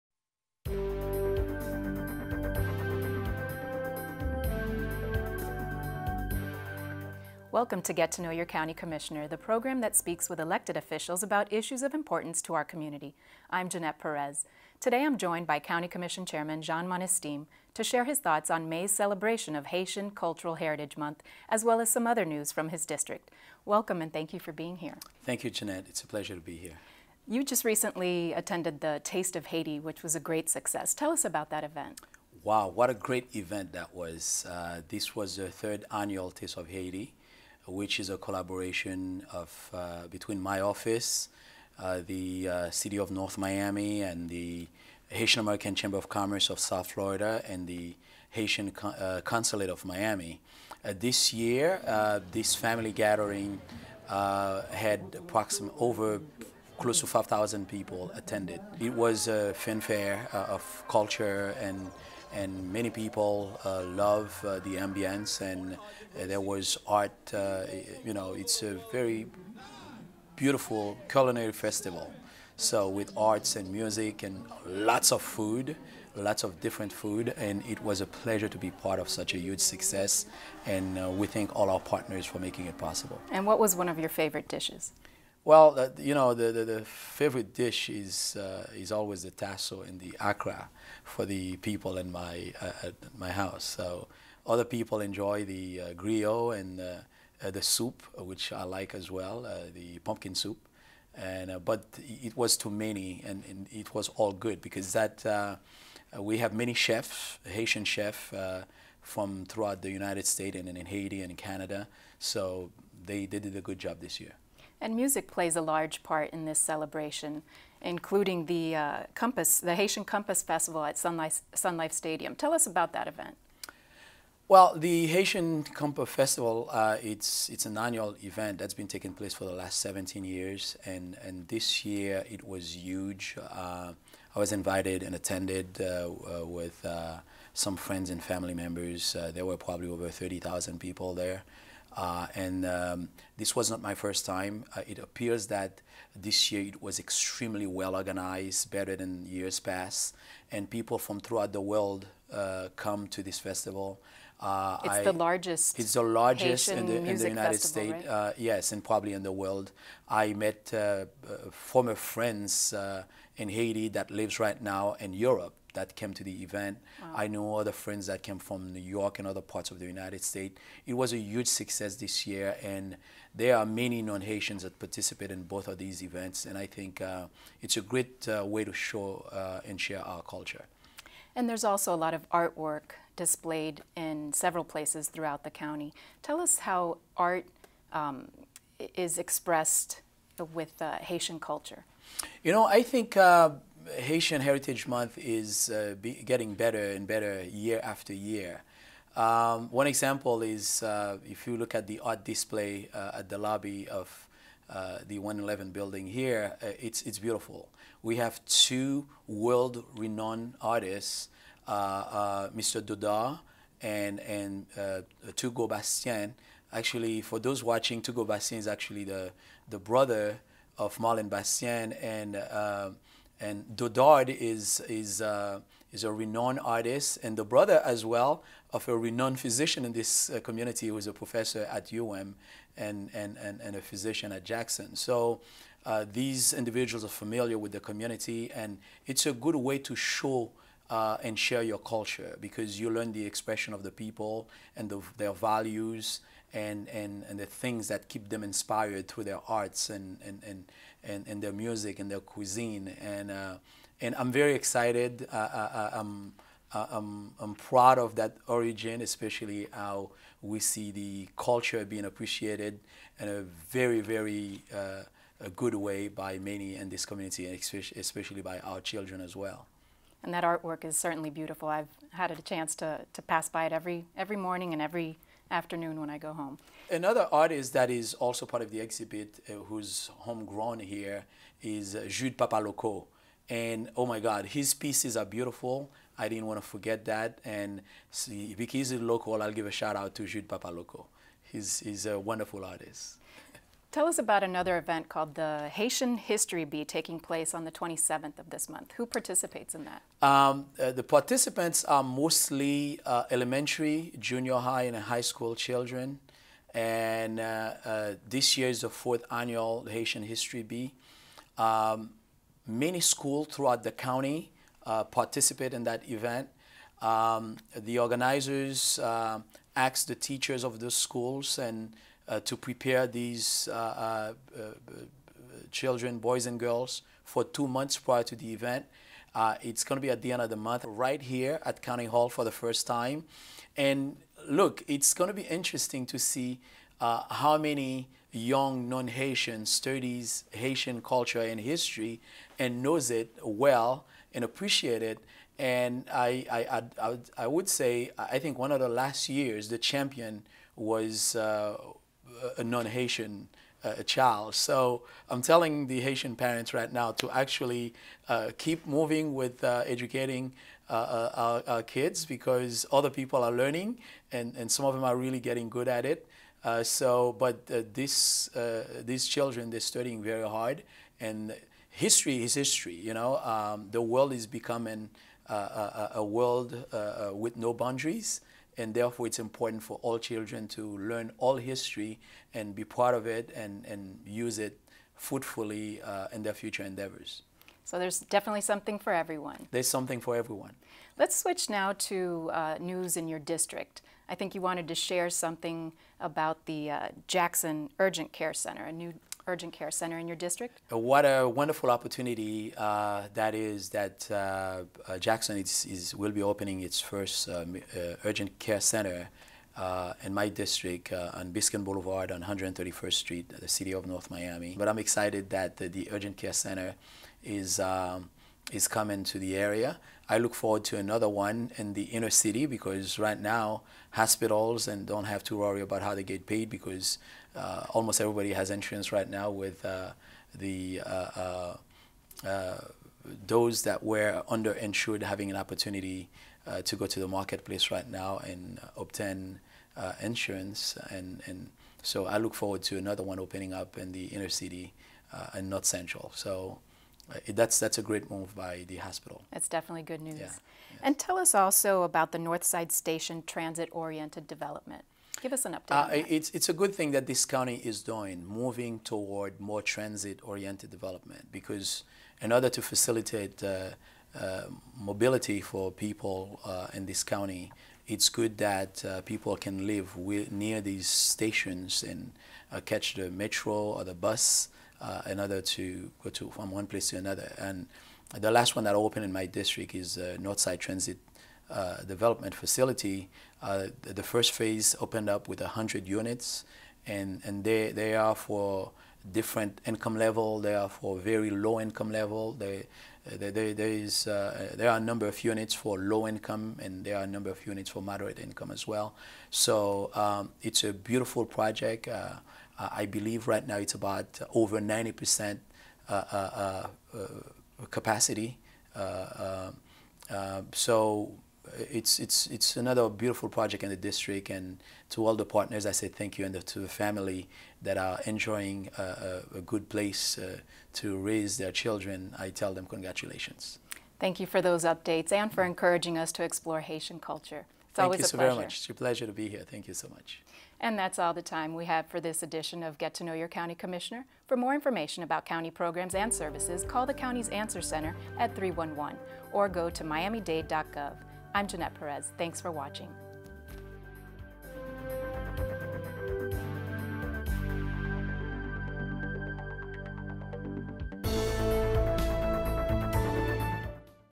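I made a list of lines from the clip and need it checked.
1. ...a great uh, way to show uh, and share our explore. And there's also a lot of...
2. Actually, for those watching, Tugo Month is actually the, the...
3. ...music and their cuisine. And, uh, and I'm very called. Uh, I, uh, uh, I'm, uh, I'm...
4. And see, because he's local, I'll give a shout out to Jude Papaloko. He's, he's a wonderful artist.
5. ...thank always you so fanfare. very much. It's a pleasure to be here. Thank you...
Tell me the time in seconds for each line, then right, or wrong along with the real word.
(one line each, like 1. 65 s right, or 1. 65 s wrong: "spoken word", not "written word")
1. 177 s wrong: "culture", not "explore"
2. 216 s wrong: "Bastien", not "Month"
3. 251 s wrong: "excited", not "called"
4. 287 s right
5. 527 s wrong: "pleasure", not "fanfare".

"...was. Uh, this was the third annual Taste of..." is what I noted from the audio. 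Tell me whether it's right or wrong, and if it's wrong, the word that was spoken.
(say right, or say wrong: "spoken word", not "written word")
right.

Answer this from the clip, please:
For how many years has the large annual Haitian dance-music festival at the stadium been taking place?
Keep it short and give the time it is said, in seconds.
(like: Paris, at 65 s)
17, at 129 s.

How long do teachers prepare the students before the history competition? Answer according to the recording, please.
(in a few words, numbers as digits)
two months.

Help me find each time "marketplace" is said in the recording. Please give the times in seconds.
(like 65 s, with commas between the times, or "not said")
437 s.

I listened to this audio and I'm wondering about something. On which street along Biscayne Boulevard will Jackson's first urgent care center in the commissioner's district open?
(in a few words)
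131st Street.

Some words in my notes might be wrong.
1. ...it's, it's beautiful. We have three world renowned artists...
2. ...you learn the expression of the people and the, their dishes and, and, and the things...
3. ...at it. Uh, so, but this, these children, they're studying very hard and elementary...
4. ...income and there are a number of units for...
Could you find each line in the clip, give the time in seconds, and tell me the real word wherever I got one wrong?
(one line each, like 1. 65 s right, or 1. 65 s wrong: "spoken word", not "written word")
1. 206 s wrong: "two", not "three"
2. 242 s wrong: "values", not "dishes"
3. 365 s wrong: "history", not "elementary"
4. 496 s right.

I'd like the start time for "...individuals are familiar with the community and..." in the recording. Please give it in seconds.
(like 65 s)
236 s.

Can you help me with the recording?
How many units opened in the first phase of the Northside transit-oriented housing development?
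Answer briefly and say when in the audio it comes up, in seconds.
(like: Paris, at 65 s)
100, at 485 s.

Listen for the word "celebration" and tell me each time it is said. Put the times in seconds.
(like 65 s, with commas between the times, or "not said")
18 s, 116 s.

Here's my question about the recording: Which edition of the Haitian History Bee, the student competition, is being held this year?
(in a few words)
fourth.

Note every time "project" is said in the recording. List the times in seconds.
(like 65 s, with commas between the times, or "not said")
501 s, 513 s.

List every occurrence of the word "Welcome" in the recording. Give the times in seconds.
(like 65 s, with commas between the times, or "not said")
7 s, 23 s.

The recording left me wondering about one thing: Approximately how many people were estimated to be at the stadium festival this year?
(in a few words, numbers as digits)
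over 30,000.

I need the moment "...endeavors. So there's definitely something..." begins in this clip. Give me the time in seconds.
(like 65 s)
386 s.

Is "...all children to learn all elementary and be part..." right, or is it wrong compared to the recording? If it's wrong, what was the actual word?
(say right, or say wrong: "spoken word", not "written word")
wrong: "history", not "elementary".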